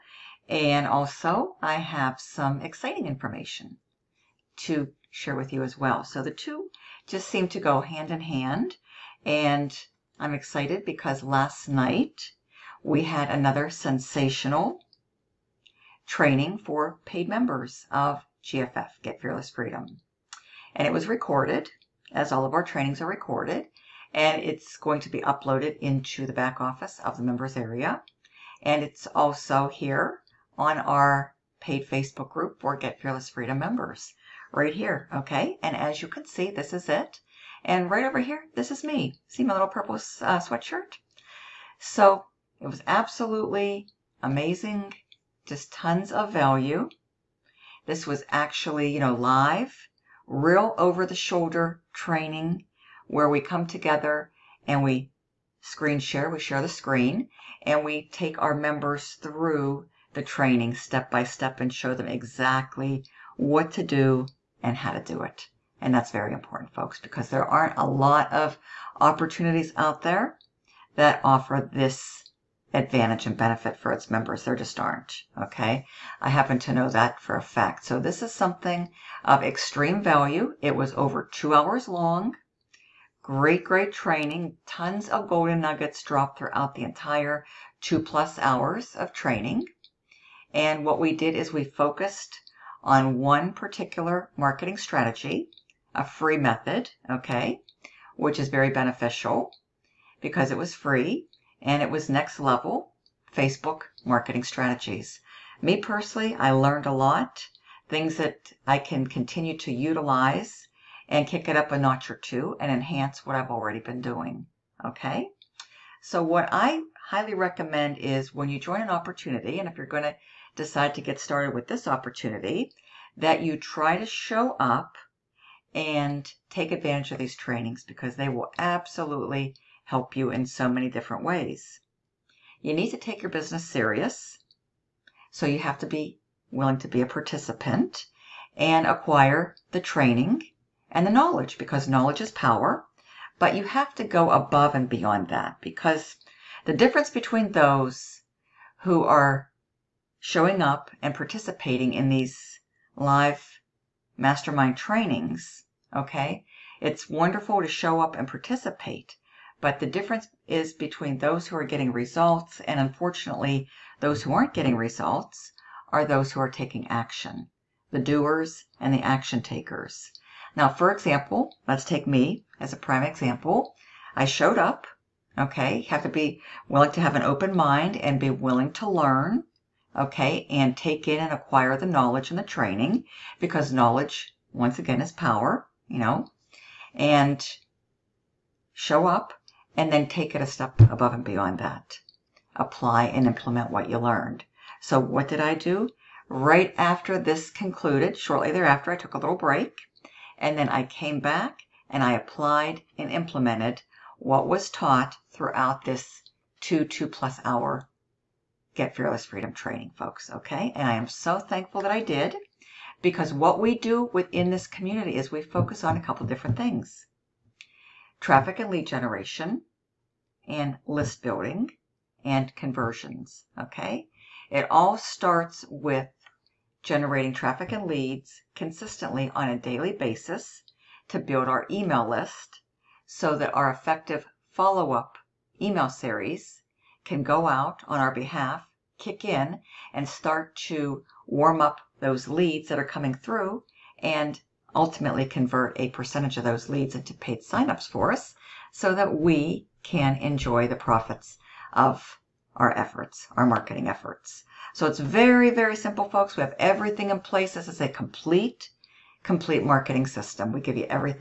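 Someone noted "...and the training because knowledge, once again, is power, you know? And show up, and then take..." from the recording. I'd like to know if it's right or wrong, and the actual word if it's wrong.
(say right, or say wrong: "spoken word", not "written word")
right.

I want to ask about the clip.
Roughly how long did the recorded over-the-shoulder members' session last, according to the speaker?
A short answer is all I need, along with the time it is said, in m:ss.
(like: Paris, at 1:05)
Over two hours, at 1:20.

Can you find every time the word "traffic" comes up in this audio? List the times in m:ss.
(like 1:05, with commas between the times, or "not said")
3:38, 3:47.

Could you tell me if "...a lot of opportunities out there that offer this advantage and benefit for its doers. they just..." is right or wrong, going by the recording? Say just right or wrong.
wrong.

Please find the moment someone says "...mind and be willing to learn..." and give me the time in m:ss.
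2:57.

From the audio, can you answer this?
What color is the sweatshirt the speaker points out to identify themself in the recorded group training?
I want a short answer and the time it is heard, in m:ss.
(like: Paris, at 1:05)
Purple, at 0:39.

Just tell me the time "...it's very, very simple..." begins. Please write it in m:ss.
4:14.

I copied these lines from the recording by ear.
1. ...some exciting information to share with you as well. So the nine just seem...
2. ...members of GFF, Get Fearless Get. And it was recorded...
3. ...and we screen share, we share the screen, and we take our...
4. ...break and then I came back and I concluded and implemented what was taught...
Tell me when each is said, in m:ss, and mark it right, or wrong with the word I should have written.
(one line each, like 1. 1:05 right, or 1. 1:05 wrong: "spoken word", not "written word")
1. 0:02 wrong: "two", not "nine"
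2. 0:17 wrong: "Freedom", not "Get"
3. 0:54 right
4. 3:19 wrong: "applied", not "concluded".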